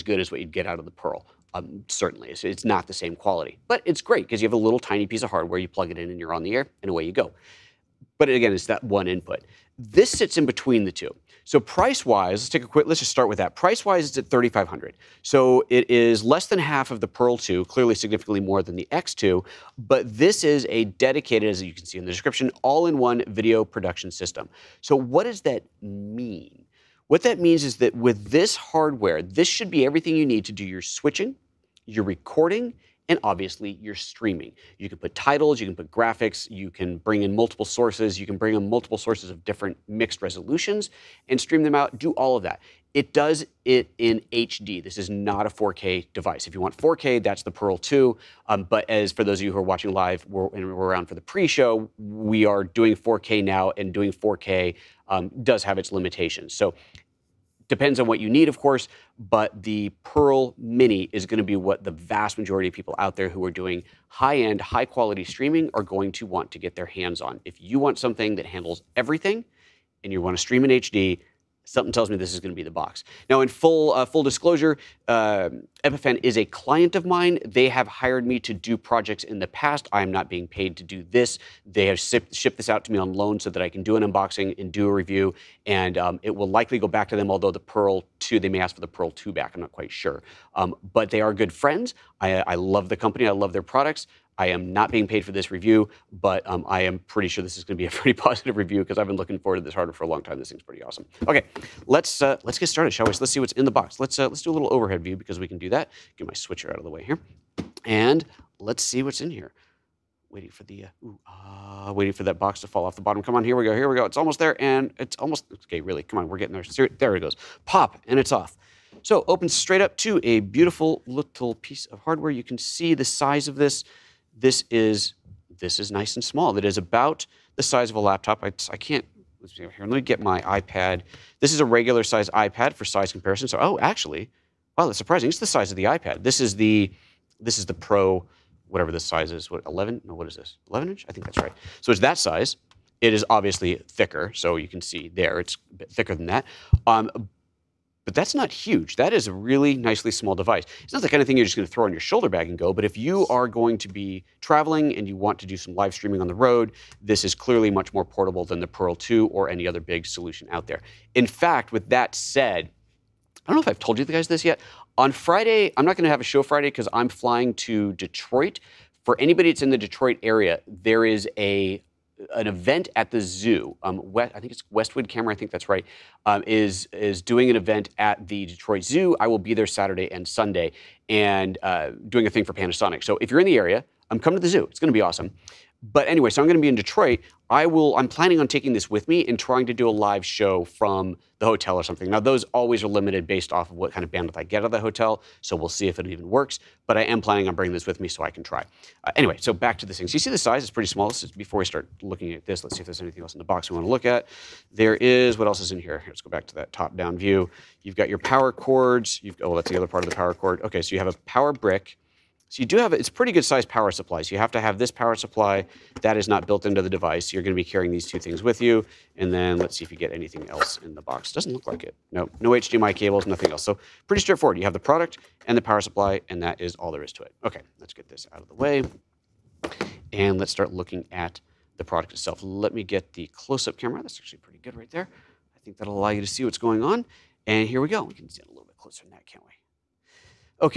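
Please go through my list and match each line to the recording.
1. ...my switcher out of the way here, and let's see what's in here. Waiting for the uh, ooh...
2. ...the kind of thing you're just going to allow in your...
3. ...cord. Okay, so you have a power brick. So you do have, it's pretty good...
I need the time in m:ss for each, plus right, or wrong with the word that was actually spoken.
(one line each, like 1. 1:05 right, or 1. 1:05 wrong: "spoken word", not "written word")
1. 1:46 right
2. 2:31 wrong: "throw", not "allow"
3. 3:30 right.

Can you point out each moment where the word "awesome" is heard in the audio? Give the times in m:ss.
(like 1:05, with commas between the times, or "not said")
1:40, 3:05.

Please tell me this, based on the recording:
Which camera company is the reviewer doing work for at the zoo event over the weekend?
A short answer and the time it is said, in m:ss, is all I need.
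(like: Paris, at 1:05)
Panasonic, at 3:02.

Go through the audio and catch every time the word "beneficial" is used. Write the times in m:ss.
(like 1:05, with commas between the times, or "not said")
not said.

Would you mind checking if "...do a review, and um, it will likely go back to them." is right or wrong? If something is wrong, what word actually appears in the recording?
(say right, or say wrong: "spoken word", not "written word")
right.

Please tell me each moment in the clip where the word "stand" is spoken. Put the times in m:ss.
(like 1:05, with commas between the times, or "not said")
3:58.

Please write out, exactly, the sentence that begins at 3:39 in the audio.
And then let's see if you get anything else in the box.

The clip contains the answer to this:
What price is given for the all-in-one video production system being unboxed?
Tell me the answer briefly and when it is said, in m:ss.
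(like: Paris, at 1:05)
3,500, at 0:14.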